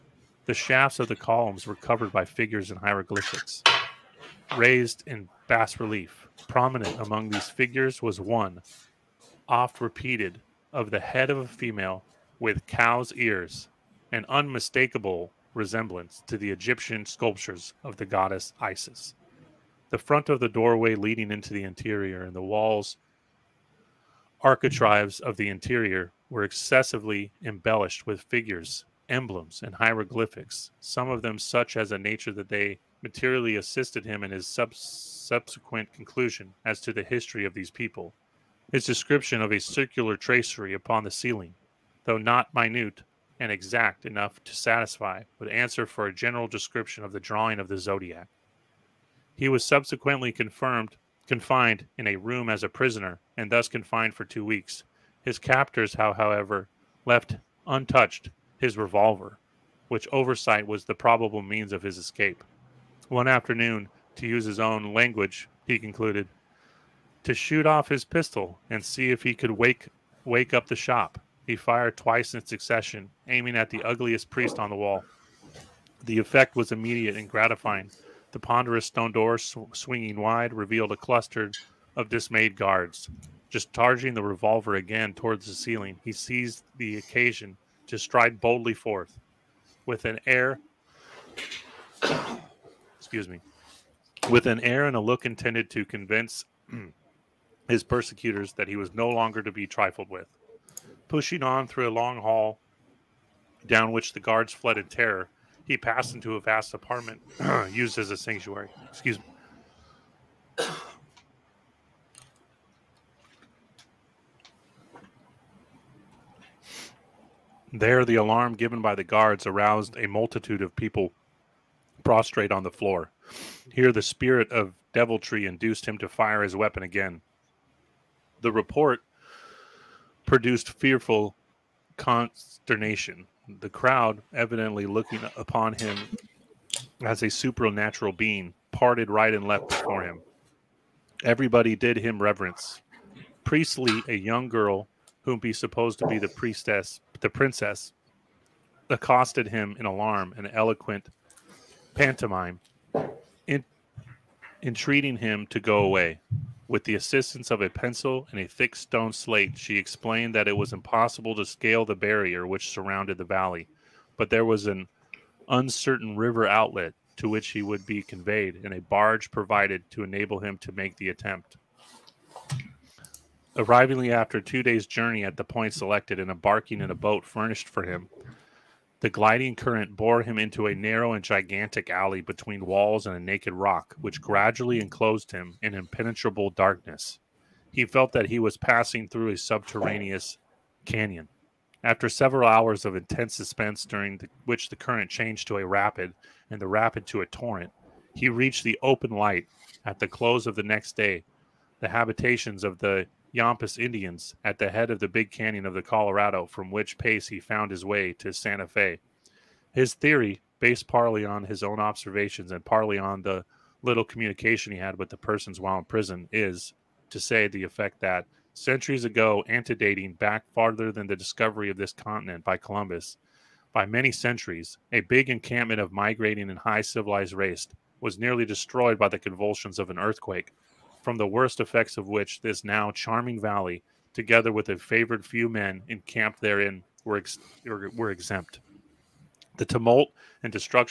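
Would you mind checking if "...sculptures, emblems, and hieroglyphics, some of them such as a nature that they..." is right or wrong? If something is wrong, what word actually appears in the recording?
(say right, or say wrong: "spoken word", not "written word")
wrong: "figures", not "sculptures".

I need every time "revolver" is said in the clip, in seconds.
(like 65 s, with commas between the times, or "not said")
58 s, 84 s.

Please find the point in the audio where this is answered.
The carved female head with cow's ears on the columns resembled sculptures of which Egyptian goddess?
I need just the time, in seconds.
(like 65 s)
18 s.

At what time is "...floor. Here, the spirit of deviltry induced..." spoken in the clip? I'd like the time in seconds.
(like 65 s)
122 s.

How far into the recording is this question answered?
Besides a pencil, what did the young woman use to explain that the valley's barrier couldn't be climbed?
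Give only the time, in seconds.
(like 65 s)
158 s.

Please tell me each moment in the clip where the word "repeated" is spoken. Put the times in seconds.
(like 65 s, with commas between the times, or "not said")
9 s.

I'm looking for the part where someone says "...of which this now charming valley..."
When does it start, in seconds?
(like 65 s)
231 s.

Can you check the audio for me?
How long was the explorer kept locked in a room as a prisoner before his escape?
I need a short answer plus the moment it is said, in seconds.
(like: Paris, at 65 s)
2 weeks, at 54 s.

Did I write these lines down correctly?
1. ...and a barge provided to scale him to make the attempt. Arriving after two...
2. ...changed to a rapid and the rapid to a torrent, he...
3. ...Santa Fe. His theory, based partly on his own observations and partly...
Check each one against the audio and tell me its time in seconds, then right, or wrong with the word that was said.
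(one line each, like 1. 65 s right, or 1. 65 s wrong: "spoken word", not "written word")
1. 168 s wrong: "enable", not "scale"
2. 195 s right
3. 208 s right.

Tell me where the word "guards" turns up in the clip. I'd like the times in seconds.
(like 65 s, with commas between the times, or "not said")
82 s, 104 s, 119 s.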